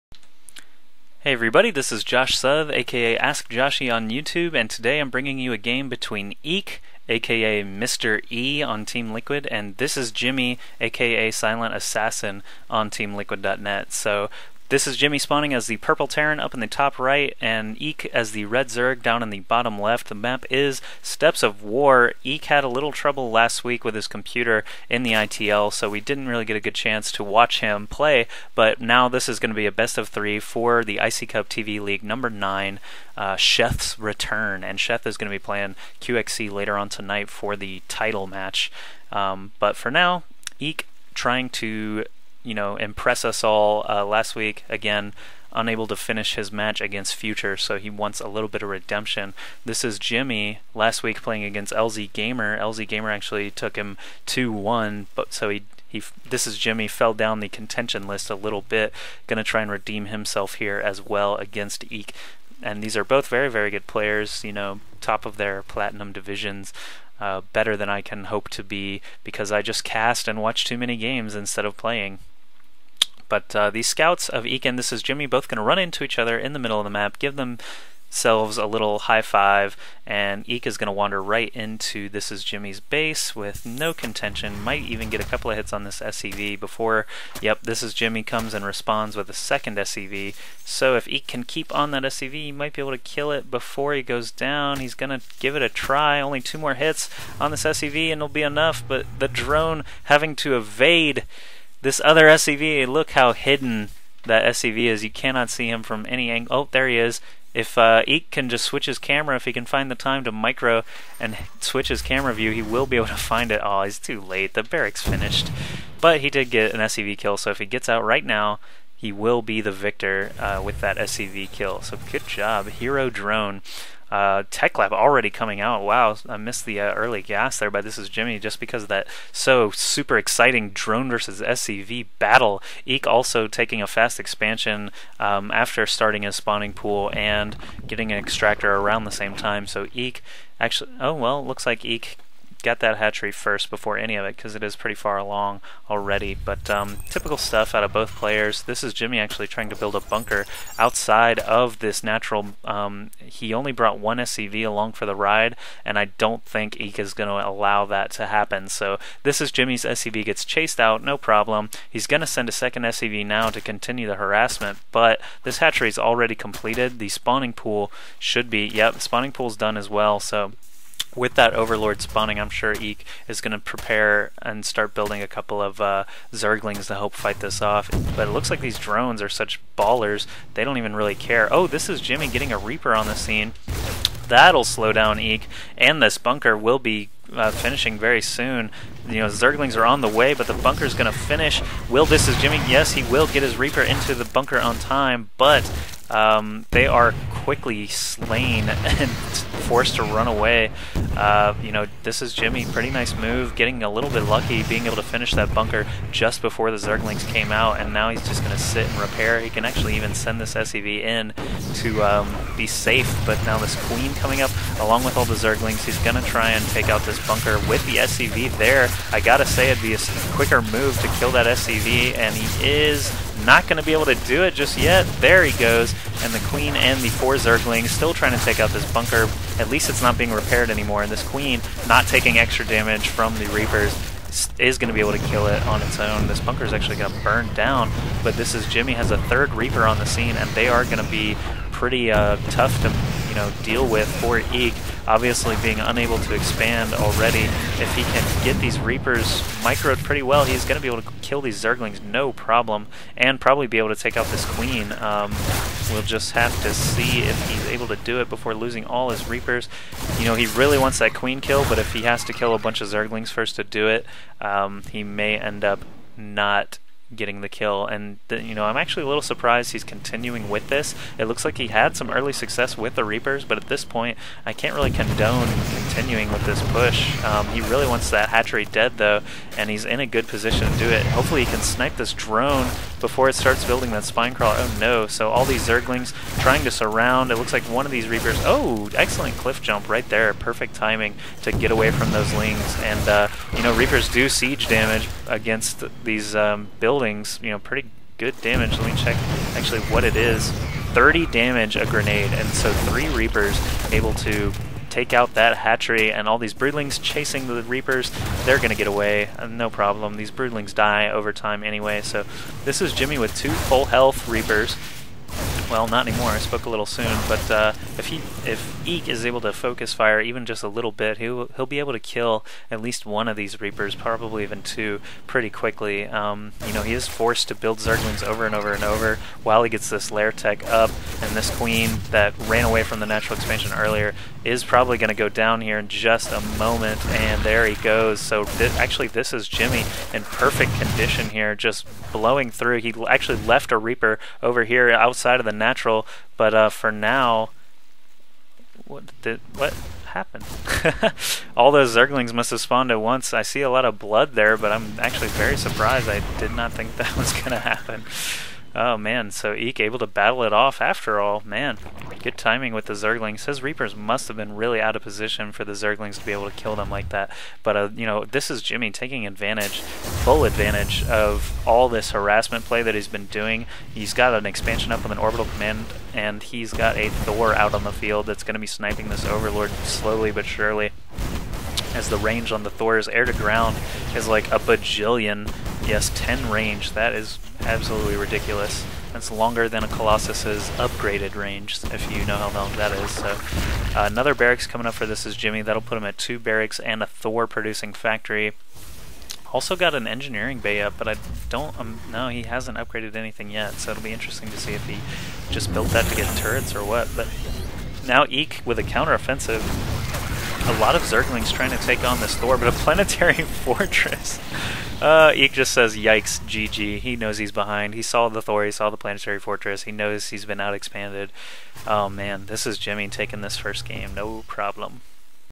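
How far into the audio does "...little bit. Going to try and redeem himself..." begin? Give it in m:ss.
0:58.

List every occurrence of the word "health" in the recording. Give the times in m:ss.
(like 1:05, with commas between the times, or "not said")
5:13.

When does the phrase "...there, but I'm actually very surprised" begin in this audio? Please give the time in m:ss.
5:54.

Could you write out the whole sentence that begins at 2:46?
The spawning pool should be, yep, spawning pool's done as well.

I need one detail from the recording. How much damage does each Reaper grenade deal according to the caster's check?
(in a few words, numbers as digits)
30.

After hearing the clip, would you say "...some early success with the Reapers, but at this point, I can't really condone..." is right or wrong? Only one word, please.
right.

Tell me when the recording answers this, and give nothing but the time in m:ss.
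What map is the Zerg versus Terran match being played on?
0:21.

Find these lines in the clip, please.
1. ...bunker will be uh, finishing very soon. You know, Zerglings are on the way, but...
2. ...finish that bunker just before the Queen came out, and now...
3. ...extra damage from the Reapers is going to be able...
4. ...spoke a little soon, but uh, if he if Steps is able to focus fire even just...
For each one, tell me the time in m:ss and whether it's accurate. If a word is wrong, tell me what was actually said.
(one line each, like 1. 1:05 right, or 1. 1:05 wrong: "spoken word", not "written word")
1. 3:06 right
2. 3:25 wrong: "Zerglings", not "Queen"
3. 3:52 right
4. 5:16 wrong: "Eek", not "Steps".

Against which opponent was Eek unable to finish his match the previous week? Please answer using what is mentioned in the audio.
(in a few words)
Future.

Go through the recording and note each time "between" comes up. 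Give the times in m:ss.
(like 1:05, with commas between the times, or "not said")
0:05.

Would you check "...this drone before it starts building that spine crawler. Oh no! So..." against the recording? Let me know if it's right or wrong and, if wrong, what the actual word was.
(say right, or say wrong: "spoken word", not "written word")
right.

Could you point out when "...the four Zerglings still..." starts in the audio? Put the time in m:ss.
3:47.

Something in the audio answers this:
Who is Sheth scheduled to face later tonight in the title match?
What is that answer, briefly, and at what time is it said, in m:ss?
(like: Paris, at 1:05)
QXC, at 0:35.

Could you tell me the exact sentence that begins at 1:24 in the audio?
Might even get a couple of hits on this SCV before, yep, this is Jimmy comes and responds with a second SCV.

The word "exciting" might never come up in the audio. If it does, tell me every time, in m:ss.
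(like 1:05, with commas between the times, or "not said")
2:10.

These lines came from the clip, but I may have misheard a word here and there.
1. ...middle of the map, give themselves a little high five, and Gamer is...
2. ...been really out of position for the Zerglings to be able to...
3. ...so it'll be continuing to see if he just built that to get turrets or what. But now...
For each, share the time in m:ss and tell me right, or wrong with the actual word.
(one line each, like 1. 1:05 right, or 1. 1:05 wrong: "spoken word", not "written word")
1. 1:16 wrong: "Eek", not "Gamer"
2. 6:04 right
3. 6:43 wrong: "interesting", not "continuing".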